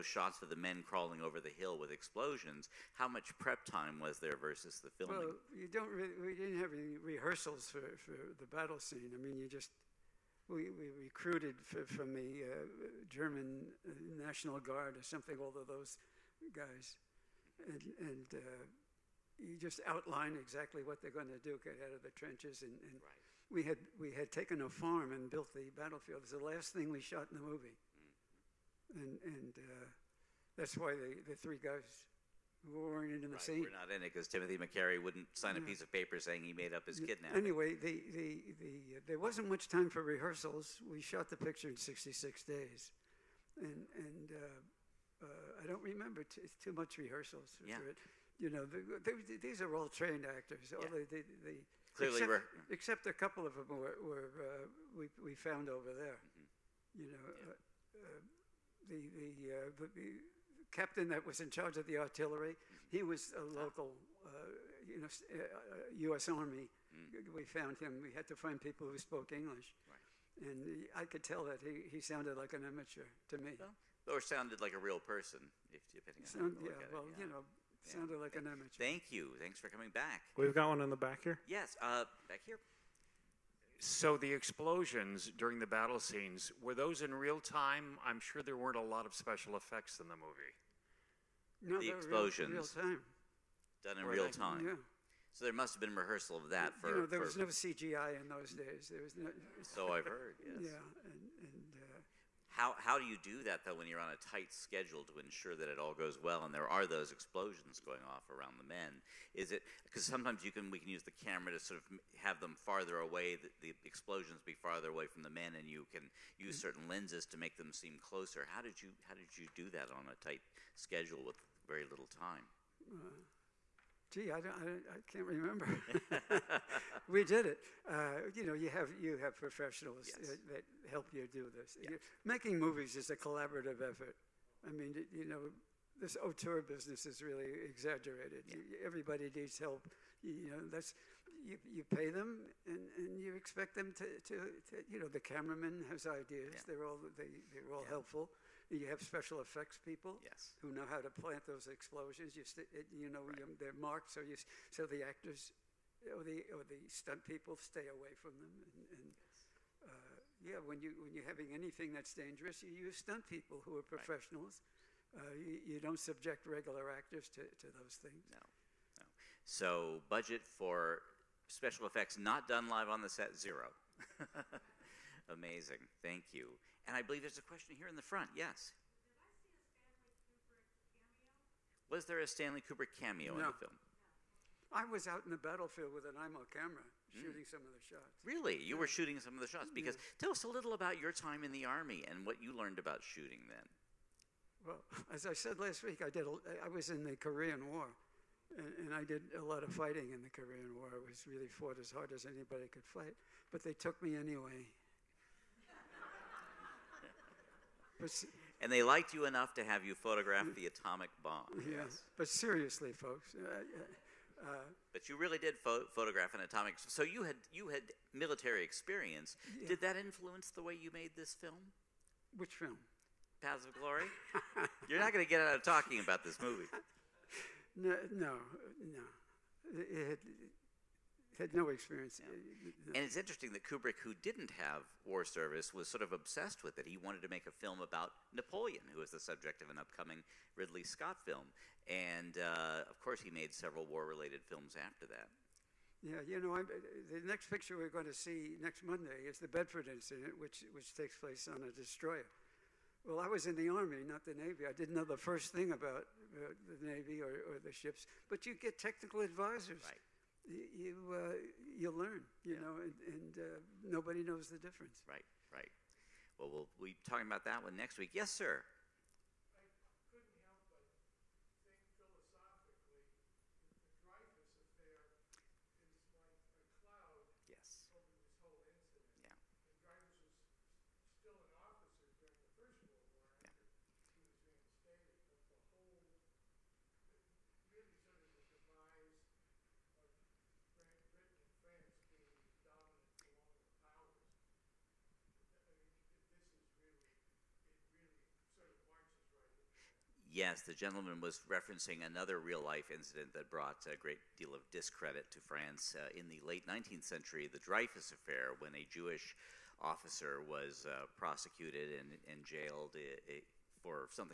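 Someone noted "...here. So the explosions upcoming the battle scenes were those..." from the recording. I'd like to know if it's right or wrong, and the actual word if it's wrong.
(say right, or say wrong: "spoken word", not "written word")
wrong: "during", not "upcoming".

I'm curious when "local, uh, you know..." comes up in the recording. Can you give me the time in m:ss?
1:03.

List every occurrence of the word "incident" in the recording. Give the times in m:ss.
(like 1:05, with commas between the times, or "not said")
4:09, 5:02.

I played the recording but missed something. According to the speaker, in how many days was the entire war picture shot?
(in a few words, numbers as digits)
66.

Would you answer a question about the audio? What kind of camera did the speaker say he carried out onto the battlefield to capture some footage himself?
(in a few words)
Eyemo.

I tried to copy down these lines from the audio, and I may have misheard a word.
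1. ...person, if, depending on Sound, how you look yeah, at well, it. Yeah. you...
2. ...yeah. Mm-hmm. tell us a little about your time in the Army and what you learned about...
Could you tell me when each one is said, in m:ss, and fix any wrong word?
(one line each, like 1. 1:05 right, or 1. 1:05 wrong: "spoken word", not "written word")
1. 1:14 right
2. 3:09 right.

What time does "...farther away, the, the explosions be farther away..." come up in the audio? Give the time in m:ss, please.
1:52.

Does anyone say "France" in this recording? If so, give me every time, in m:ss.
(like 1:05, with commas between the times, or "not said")
5:05.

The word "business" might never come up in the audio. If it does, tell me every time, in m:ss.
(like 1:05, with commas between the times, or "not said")
2:16.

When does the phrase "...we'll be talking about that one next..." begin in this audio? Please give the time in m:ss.
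4:26.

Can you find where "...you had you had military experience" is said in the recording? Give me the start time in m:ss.
3:37.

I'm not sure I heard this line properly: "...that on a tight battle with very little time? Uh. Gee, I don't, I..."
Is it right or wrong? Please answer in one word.
wrong.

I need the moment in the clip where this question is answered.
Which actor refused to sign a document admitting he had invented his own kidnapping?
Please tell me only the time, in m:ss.
0:34.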